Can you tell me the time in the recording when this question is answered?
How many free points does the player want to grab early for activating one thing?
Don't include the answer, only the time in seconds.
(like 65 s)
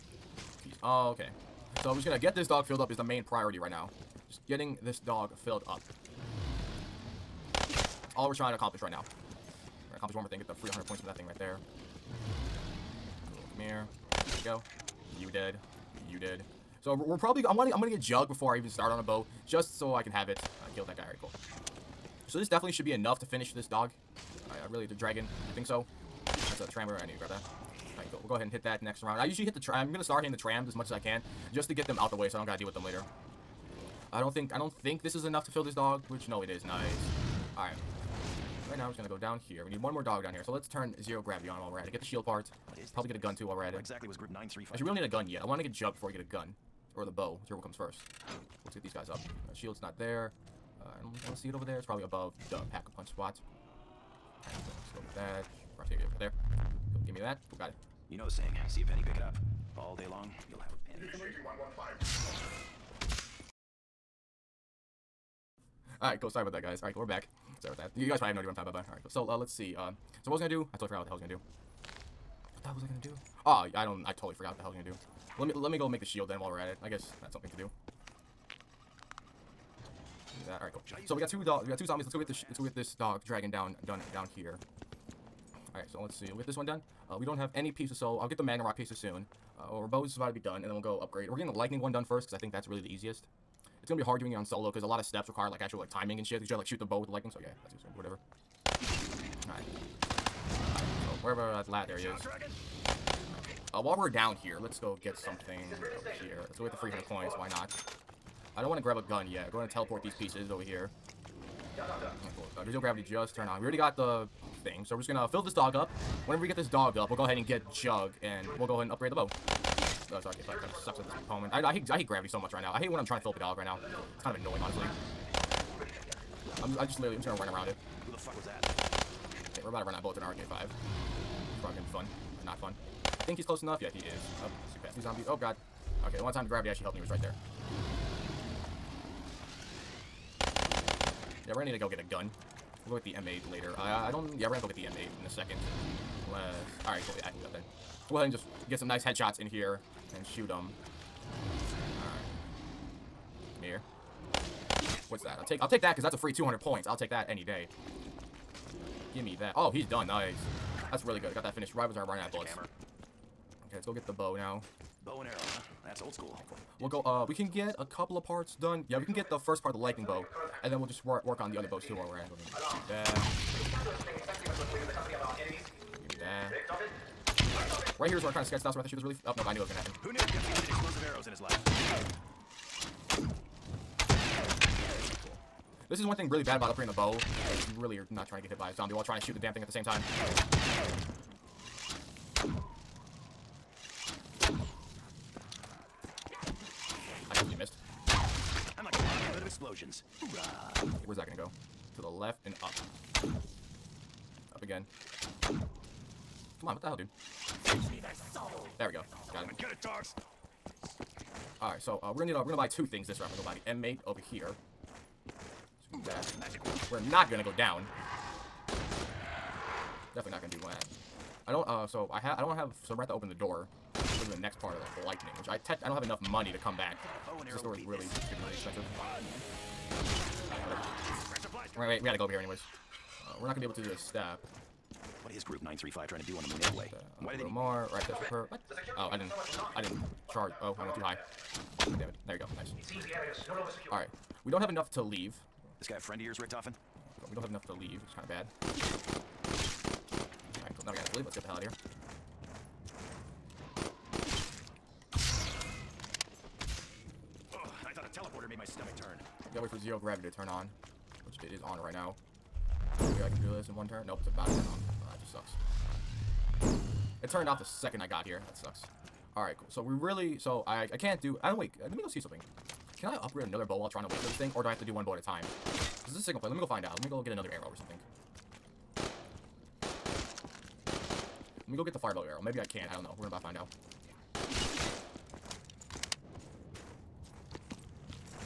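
10 s.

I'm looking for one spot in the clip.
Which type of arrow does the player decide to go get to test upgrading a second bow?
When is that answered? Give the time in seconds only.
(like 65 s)
281 s.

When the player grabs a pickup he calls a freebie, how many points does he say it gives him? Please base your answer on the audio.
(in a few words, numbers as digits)
200.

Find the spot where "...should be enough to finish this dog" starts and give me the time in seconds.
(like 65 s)
22 s.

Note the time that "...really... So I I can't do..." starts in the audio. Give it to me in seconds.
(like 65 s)
269 s.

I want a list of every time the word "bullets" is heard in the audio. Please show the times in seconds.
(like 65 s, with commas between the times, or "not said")
130 s, 162 s.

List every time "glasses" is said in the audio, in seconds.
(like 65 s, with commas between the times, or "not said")
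not said.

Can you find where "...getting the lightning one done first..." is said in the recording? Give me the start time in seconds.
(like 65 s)
91 s.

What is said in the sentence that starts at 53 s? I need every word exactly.
so let's go get that right there.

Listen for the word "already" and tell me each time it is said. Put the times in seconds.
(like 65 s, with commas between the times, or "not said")
21 s, 113 s.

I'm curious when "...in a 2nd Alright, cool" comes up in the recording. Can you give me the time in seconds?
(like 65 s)
145 s.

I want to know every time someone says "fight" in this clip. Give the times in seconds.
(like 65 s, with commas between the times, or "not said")
120 s.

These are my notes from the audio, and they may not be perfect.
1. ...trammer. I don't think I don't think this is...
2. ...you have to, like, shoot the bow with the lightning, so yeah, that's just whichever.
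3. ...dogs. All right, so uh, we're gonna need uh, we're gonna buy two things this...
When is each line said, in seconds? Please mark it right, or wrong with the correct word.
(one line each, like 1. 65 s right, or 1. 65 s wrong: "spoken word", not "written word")
1. 32 s wrong: "later", not "trammer"
2. 96 s wrong: "whatever", not "whichever"
3. 209 s right.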